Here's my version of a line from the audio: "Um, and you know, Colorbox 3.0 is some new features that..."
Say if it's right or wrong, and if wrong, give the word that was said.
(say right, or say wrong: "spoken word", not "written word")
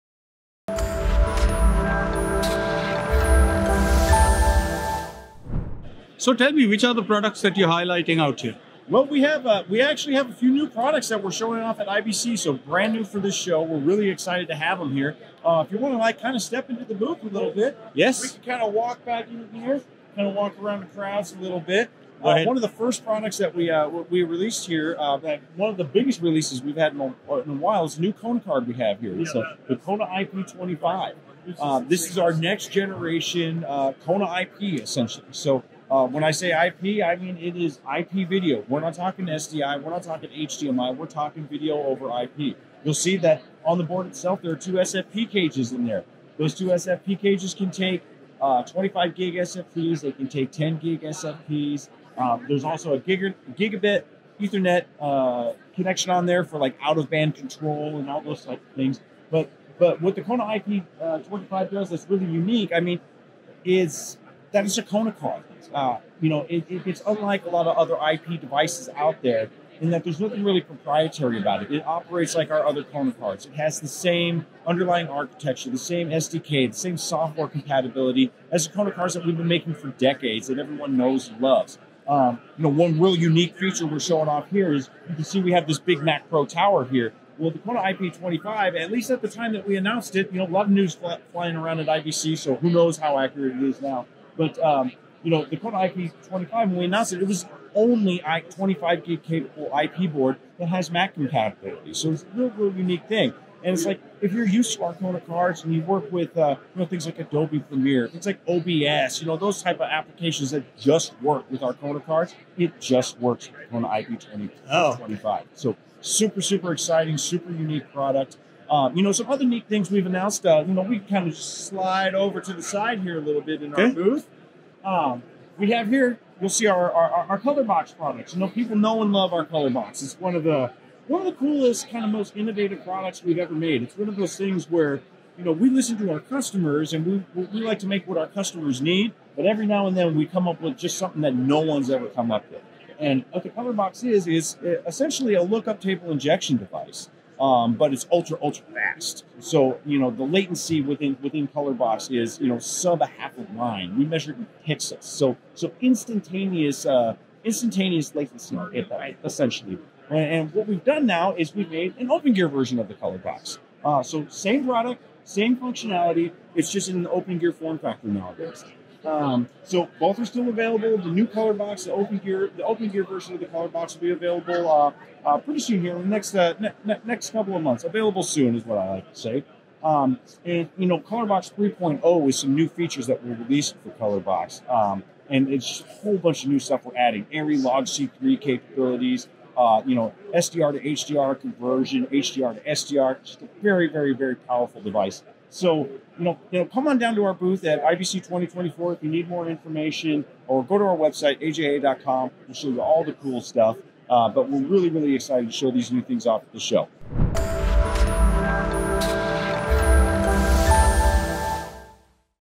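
right.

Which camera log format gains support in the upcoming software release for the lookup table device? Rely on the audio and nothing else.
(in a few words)
ARRI Log C3.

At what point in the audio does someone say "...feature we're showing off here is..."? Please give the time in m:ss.
1:23.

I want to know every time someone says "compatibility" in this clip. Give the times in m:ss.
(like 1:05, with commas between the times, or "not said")
1:17, 1:41.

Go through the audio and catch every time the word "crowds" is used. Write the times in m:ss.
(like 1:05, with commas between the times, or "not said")
0:20.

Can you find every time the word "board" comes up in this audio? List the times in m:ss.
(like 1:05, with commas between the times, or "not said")
0:43, 1:40.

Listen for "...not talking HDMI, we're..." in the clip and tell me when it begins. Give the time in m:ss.
0:39.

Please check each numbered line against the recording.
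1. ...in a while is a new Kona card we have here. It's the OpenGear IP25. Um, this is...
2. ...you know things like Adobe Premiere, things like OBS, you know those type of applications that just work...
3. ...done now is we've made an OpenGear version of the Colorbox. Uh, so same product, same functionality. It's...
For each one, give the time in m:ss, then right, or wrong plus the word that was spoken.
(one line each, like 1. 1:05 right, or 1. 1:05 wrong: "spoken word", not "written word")
1. 0:27 wrong: "Kona", not "OpenGear"
2. 1:46 right
3. 2:40 right.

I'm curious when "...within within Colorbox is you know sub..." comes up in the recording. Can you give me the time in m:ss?
2:30.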